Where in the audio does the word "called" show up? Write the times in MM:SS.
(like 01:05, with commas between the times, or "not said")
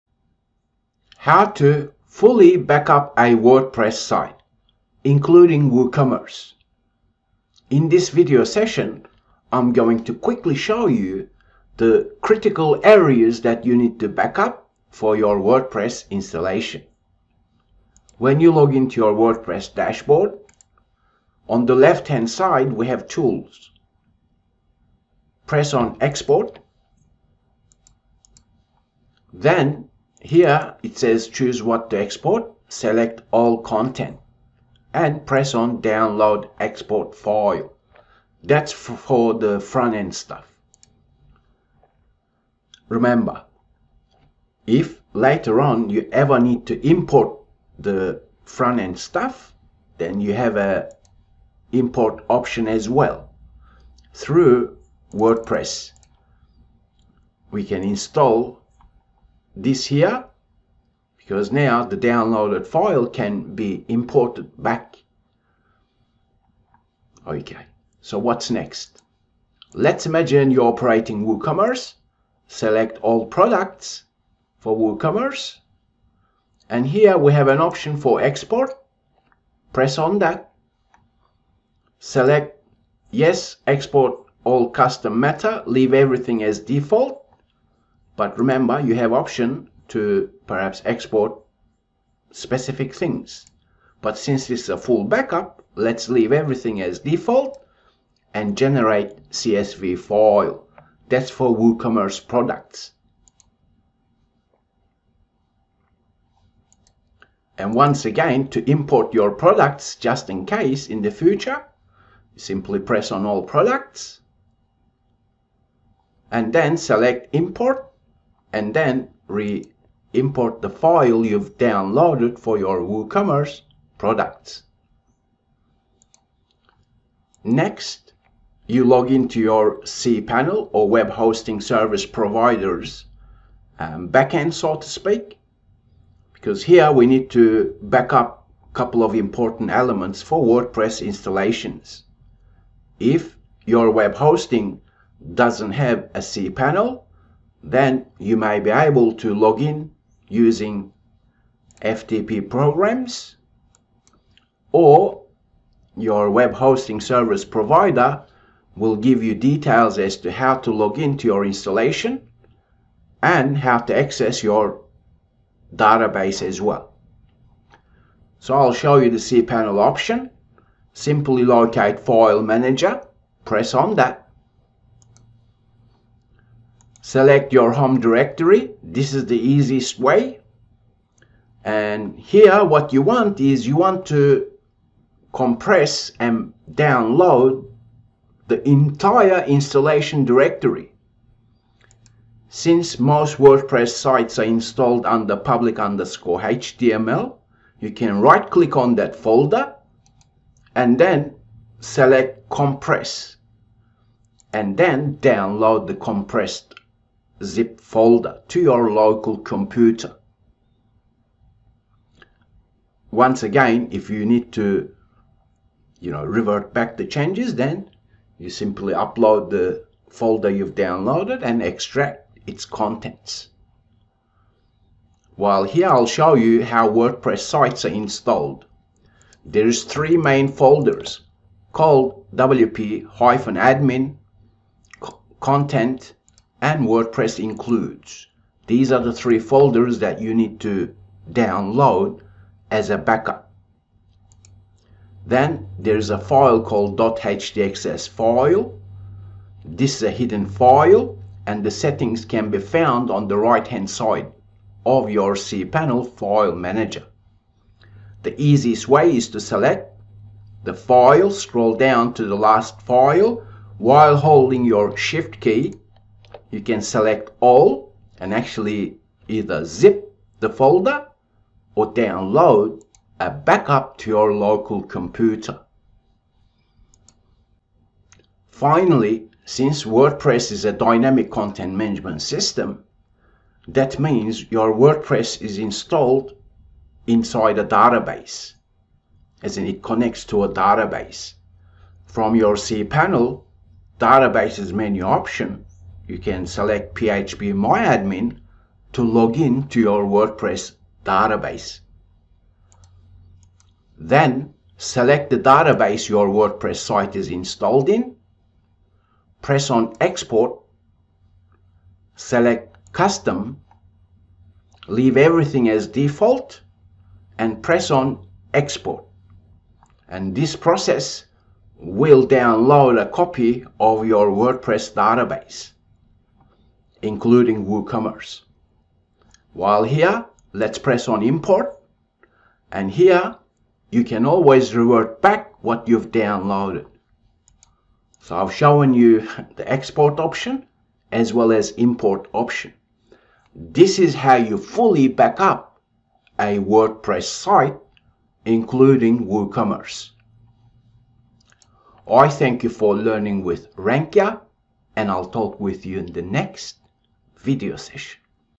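03:51, 04:06.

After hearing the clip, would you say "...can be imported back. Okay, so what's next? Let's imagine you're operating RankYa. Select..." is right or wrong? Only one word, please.
wrong.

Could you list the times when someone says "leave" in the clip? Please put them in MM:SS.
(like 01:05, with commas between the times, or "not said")
01:25, 01:36, 05:14.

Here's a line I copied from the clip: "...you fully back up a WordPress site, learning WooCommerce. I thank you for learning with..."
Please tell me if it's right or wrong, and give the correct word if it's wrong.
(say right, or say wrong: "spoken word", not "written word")
wrong: "including", not "learning".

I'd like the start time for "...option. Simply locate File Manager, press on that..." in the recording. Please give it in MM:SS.
02:49.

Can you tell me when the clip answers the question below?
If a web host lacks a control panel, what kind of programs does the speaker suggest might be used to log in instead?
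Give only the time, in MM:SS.
02:31.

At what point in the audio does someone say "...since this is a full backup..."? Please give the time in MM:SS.
01:34.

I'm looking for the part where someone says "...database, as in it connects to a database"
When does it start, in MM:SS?
04:47.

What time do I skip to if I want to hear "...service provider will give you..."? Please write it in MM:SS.
02:36.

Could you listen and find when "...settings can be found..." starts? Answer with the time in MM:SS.
04:11.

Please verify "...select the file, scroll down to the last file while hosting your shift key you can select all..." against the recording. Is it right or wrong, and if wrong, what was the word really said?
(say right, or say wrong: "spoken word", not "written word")
wrong: "holding", not "hosting".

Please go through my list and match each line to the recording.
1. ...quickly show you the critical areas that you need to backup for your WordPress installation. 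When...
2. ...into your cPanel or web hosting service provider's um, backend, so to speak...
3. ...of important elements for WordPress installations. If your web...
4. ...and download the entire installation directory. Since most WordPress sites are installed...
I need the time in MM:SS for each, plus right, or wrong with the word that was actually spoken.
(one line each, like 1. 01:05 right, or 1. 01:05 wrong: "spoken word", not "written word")
1. 00:10 right
2. 02:09 right
3. 02:19 right
4. 03:06 right.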